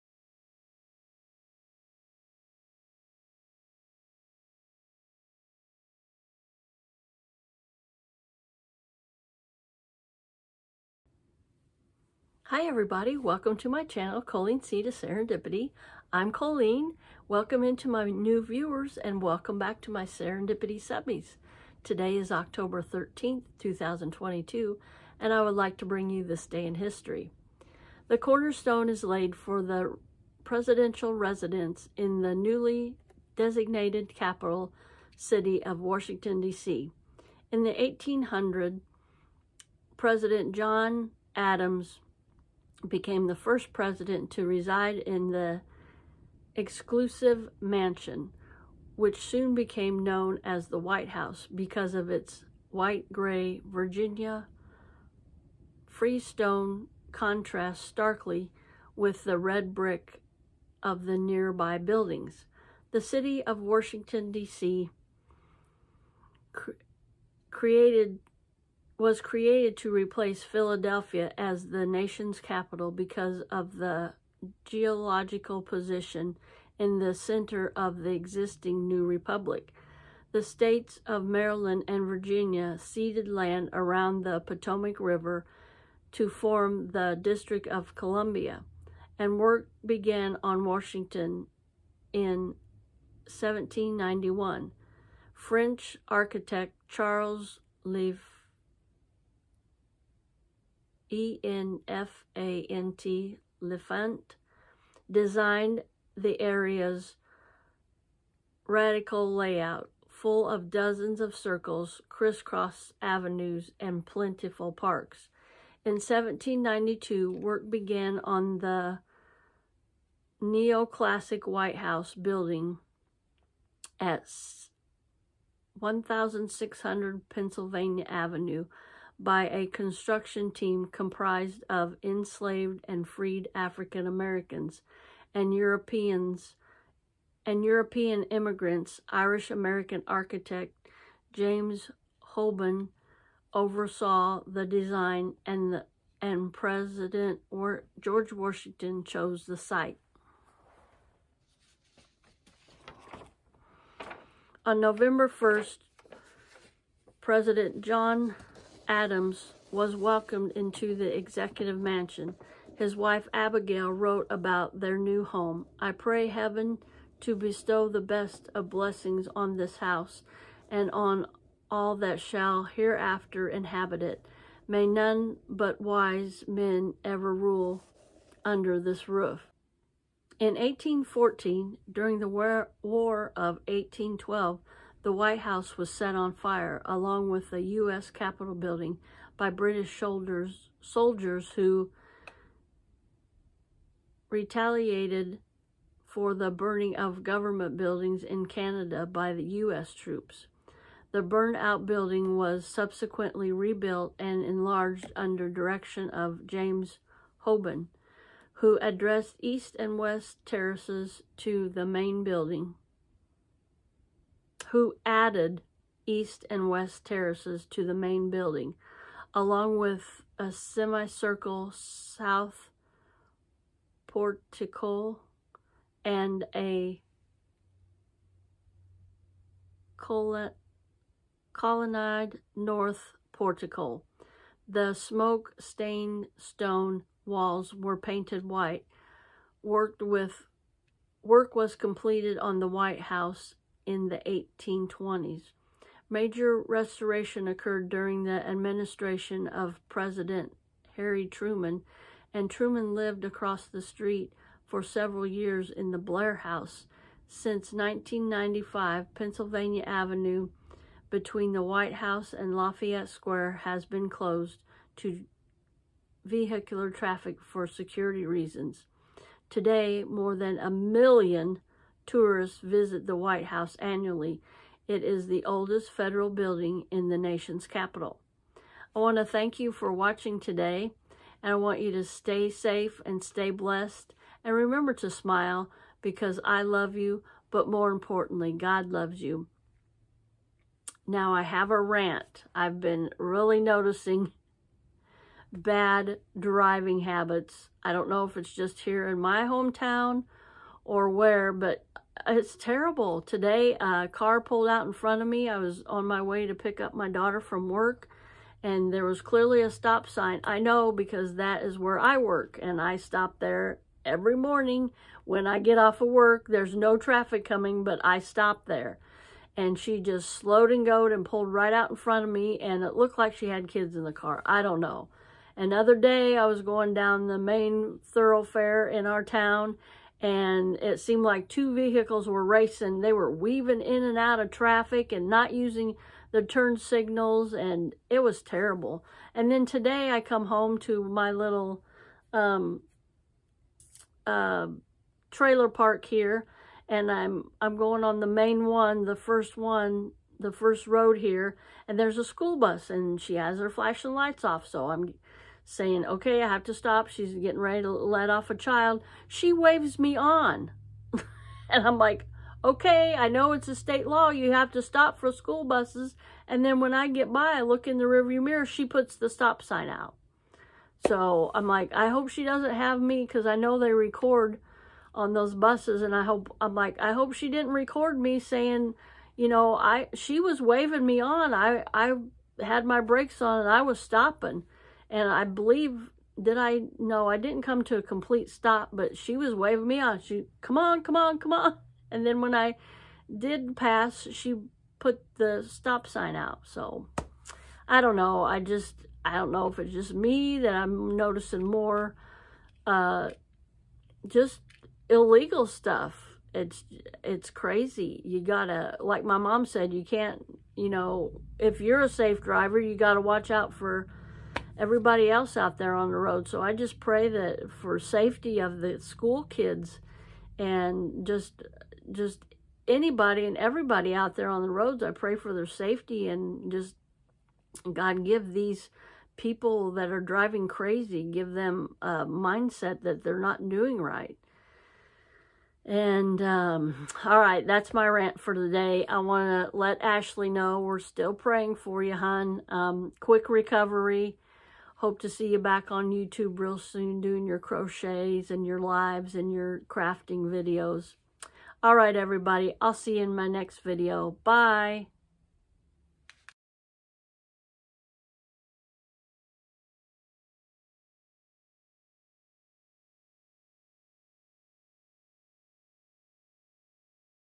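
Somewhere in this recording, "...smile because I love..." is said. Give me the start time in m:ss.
4:45.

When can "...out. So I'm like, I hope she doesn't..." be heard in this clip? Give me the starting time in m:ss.
6:09.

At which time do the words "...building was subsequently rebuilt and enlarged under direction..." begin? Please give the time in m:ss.
3:21.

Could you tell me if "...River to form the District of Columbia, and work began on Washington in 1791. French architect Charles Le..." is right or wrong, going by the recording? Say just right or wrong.
right.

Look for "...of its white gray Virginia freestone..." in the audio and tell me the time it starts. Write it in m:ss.
0:51.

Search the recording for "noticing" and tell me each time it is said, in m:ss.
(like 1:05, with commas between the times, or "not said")
4:53, 6:41.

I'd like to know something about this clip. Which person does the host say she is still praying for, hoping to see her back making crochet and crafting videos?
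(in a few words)
Ashley.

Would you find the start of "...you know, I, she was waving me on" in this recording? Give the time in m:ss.
6:19.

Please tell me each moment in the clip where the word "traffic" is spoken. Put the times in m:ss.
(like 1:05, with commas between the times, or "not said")
4:26, 5:16, 5:34.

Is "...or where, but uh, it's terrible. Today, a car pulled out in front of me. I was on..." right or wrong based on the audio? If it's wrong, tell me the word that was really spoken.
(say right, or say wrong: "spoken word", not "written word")
right.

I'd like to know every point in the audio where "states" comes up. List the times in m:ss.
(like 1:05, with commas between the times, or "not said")
1:20, 6:03.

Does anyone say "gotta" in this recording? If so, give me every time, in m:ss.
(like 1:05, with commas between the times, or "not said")
6:48, 6:52.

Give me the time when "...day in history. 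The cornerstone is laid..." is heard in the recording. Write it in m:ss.
0:26.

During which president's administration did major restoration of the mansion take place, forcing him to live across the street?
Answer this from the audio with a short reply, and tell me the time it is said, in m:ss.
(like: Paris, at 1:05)
Harry Truman, at 4:10.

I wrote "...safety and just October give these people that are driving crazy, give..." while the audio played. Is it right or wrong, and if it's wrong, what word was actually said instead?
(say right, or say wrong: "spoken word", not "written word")
wrong: "God", not "October".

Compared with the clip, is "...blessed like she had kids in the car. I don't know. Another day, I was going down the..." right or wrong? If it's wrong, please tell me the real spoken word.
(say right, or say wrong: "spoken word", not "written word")
wrong: "looked", not "blessed".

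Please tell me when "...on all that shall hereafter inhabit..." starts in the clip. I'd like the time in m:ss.
2:50.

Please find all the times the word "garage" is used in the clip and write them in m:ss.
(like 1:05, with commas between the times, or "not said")
not said.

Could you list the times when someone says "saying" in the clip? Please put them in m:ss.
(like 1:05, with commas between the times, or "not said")
5:55, 6:18.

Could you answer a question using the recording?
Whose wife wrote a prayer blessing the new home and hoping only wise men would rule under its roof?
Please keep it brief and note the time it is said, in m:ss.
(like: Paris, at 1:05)
Abigail, at 2:43.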